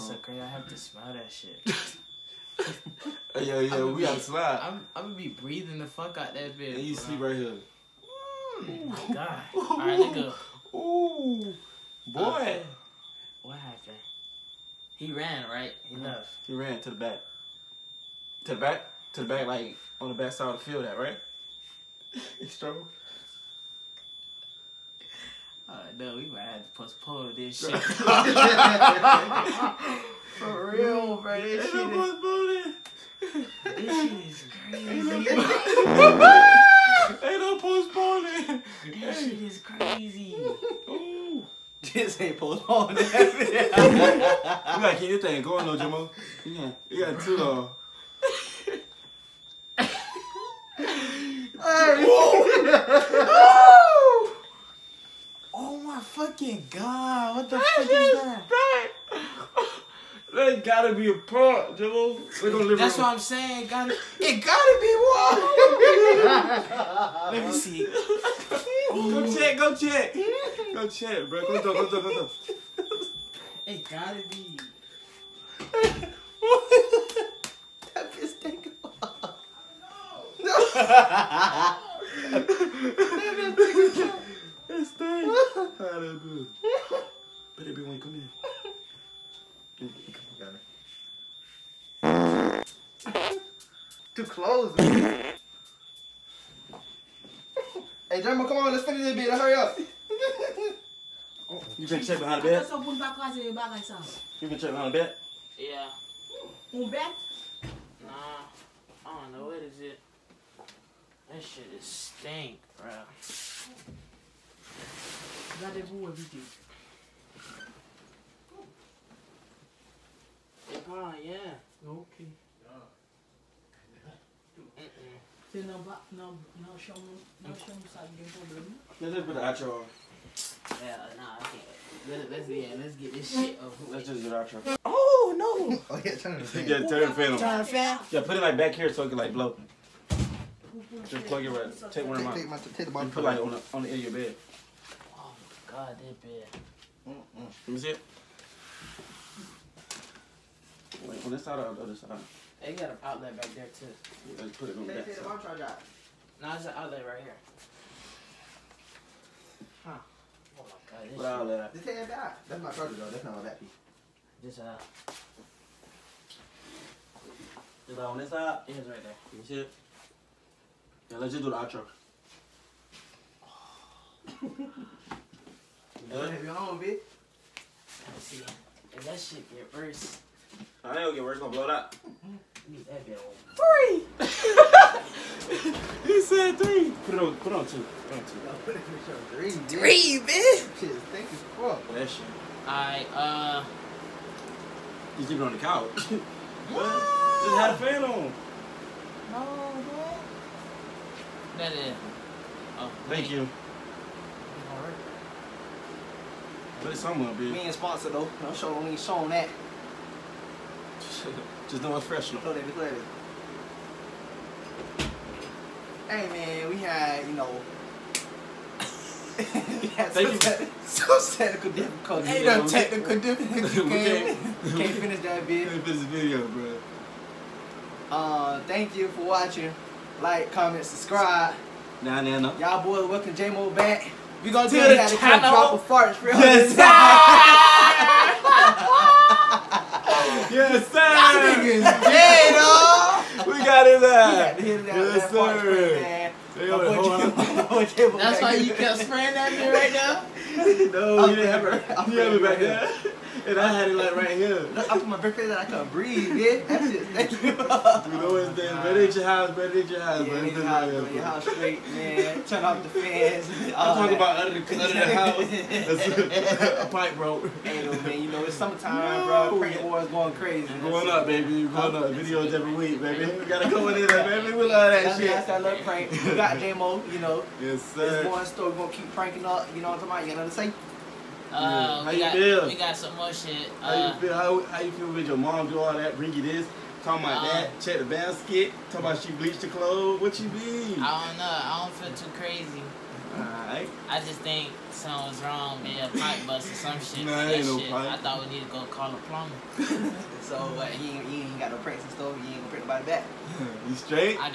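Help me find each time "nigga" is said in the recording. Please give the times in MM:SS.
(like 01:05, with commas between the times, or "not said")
00:09, 04:01.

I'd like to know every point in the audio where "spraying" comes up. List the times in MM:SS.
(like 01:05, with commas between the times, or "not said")
04:09.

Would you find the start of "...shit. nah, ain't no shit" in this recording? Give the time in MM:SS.
04:57.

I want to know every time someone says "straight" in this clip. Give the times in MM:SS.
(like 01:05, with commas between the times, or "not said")
04:21, 05:03.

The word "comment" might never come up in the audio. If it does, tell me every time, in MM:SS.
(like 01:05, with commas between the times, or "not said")
03:50.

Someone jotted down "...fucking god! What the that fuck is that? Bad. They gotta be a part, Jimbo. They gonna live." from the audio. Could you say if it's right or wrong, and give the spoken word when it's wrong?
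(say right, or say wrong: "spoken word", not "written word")
right.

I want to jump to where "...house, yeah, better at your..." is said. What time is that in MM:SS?
04:20.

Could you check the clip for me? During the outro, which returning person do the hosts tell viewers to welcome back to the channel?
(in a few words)
J-Mo.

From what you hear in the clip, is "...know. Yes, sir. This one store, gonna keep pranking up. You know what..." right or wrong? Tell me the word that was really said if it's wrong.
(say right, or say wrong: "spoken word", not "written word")
right.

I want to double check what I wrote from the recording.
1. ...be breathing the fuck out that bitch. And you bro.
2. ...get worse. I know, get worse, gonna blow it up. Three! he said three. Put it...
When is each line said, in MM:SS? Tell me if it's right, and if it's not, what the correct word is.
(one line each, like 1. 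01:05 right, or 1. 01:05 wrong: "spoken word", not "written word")
1. 00:05 right
2. 02:59 right.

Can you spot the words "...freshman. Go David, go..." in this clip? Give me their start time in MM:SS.
03:32.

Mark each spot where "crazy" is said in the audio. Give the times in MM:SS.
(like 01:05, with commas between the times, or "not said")
00:34, 00:39, 04:30, 04:52.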